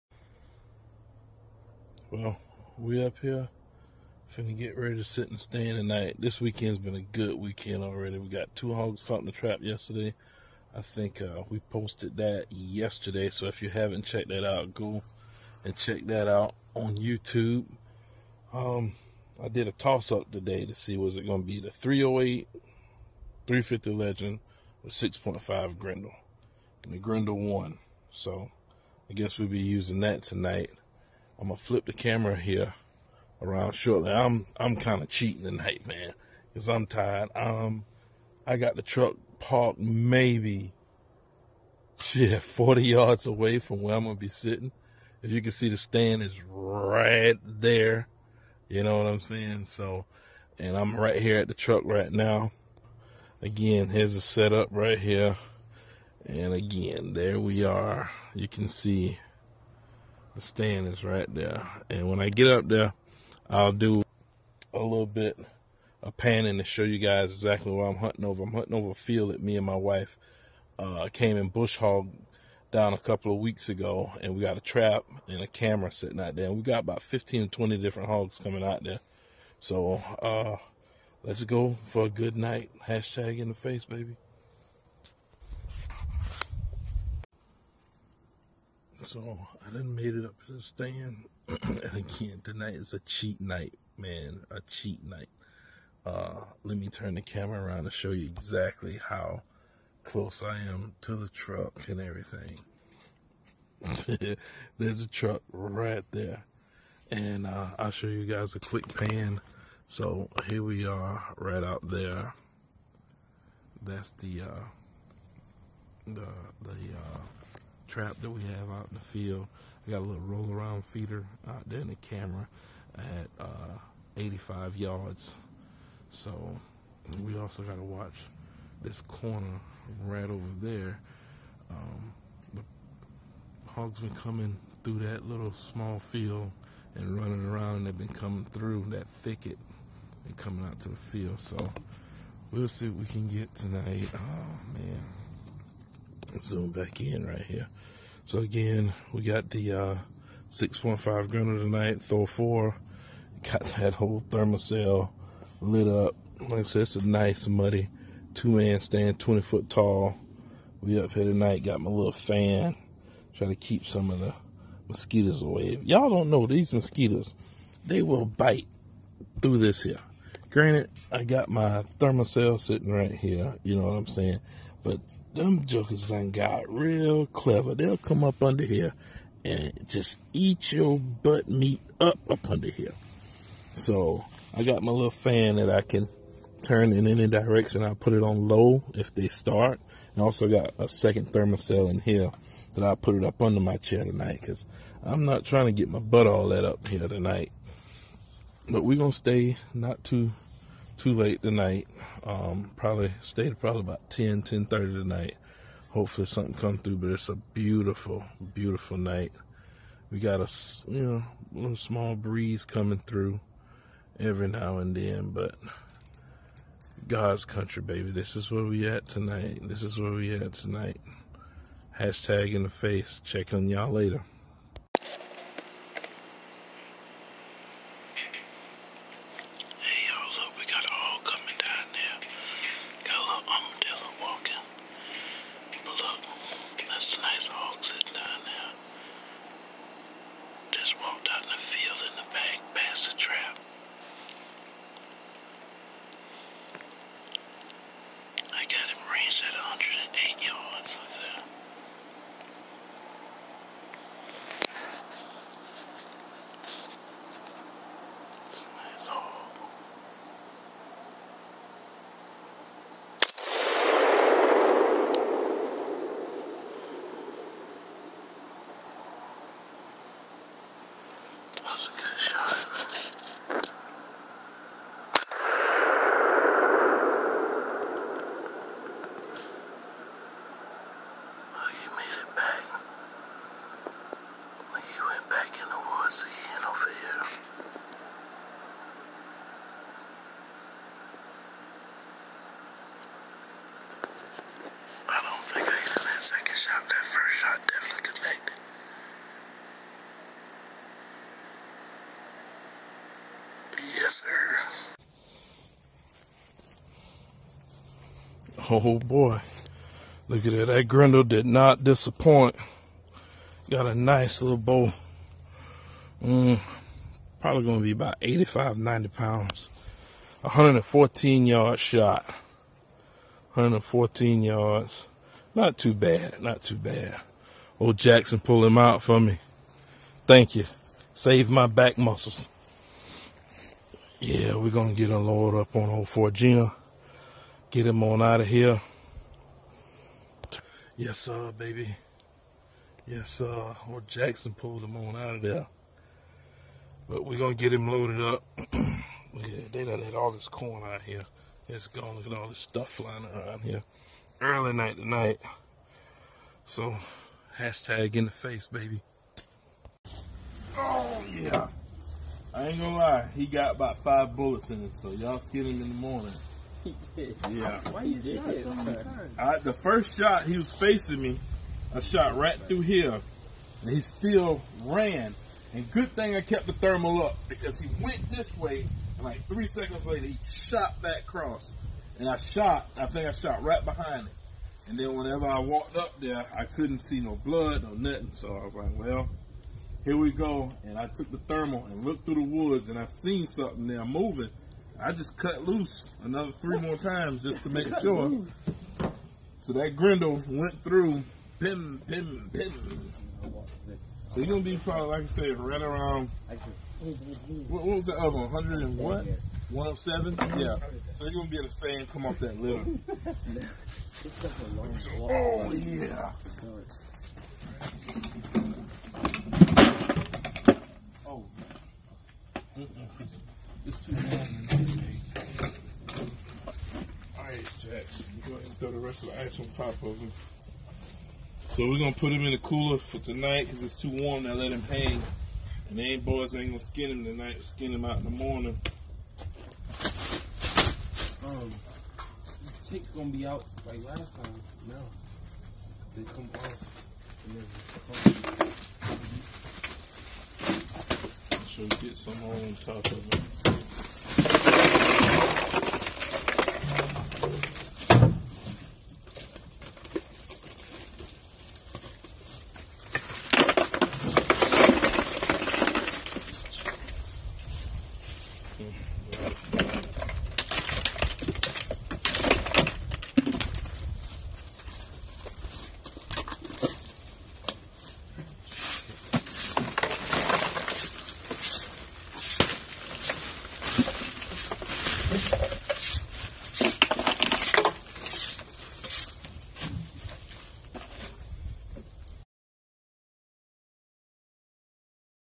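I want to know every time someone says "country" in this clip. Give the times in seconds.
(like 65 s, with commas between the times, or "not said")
217 s.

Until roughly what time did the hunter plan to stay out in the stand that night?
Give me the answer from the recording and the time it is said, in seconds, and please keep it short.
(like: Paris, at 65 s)
10:30, at 204 s.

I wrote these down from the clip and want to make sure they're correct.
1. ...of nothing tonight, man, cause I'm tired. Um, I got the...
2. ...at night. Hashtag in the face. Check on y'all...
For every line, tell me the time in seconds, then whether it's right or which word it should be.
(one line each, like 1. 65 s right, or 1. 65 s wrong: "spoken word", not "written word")
1. 35 s wrong: "cheating", not "nothing"
2. 220 s wrong: "tonight", not "night".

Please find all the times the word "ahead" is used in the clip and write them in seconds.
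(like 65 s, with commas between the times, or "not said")
428 s.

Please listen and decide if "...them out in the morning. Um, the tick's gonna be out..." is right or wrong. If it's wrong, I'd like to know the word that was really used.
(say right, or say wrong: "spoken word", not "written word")
right.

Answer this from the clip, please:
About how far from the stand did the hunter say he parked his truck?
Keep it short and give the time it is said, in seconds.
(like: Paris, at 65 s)
40 yards, at 42 s.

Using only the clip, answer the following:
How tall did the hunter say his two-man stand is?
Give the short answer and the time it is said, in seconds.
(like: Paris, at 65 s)
20 feet, at 159 s.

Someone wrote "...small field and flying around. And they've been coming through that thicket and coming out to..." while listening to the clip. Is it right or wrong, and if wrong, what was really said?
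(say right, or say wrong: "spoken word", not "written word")
wrong: "running", not "flying".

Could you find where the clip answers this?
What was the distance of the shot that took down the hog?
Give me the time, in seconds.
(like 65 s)
323 s.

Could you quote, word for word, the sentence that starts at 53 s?
Again, here's the setup right here.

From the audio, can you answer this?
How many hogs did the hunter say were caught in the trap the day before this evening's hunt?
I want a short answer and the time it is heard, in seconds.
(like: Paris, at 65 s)
2, at 8 s.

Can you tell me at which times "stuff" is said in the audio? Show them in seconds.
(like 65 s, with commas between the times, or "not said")
352 s.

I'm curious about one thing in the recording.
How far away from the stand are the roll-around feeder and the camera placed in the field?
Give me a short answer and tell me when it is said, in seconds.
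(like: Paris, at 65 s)
85 yards, at 124 s.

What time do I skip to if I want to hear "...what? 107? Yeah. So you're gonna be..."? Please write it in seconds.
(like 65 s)
408 s.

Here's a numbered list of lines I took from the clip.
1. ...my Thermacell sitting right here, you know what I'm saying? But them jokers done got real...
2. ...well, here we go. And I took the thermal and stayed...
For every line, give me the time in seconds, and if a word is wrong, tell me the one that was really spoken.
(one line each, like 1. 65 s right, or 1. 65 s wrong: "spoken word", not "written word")
1. 171 s right
2. 388 s wrong: "looked", not "stayed".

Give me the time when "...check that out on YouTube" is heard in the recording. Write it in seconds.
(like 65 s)
15 s.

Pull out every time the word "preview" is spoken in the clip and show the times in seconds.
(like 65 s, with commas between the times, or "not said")
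not said.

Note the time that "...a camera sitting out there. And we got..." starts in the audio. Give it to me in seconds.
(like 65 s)
75 s.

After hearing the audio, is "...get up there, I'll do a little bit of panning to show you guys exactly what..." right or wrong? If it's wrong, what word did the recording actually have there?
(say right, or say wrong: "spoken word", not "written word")
right.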